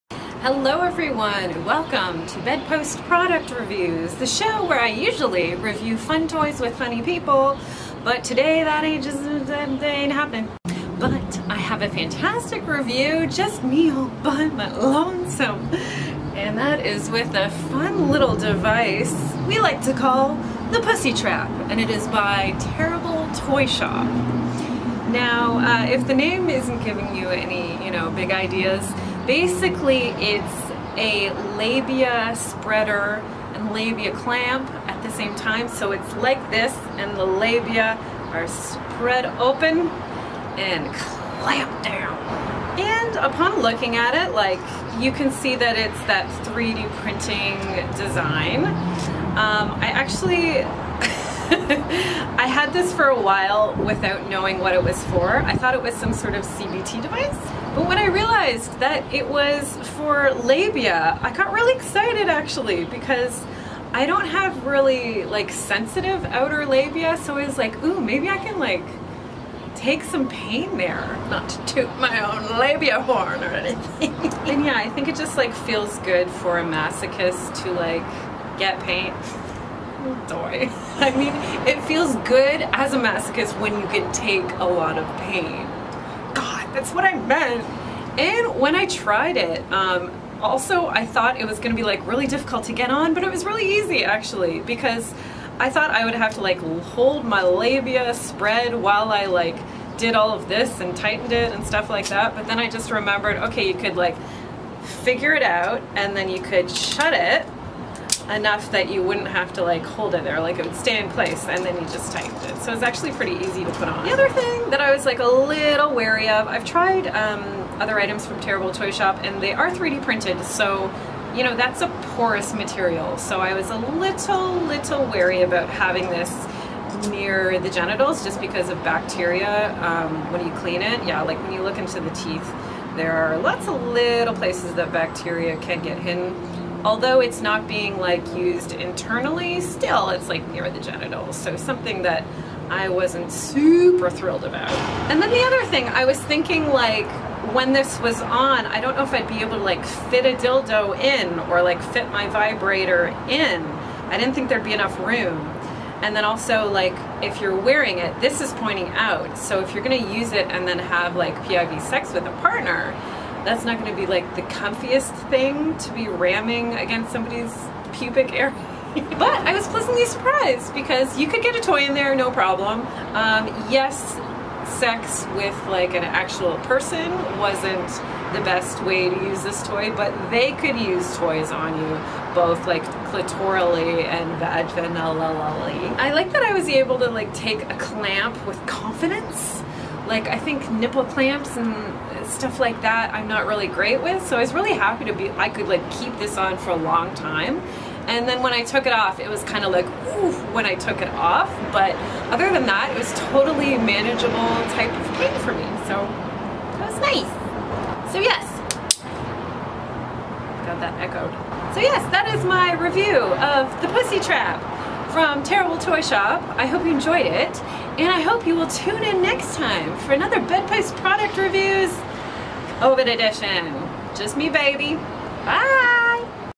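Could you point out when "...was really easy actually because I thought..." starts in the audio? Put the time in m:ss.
1:33.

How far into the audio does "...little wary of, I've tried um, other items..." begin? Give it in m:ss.
1:55.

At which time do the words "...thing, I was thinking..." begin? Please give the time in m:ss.
2:25.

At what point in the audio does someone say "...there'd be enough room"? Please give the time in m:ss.
2:34.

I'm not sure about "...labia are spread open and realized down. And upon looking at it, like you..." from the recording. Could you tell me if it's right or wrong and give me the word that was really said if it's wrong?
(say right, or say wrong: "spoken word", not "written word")
wrong: "clamped", not "realized".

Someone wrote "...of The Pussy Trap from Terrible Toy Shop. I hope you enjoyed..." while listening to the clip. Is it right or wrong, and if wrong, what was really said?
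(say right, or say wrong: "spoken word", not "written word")
right.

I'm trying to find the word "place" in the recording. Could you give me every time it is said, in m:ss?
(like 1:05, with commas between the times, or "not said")
1:51, 2:14.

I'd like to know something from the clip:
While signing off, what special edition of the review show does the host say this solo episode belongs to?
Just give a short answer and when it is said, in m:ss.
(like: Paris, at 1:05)
COVID edition, at 3:42.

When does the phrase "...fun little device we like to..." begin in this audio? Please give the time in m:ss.
0:17.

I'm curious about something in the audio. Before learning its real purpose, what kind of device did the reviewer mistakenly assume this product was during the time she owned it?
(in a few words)
CBT device.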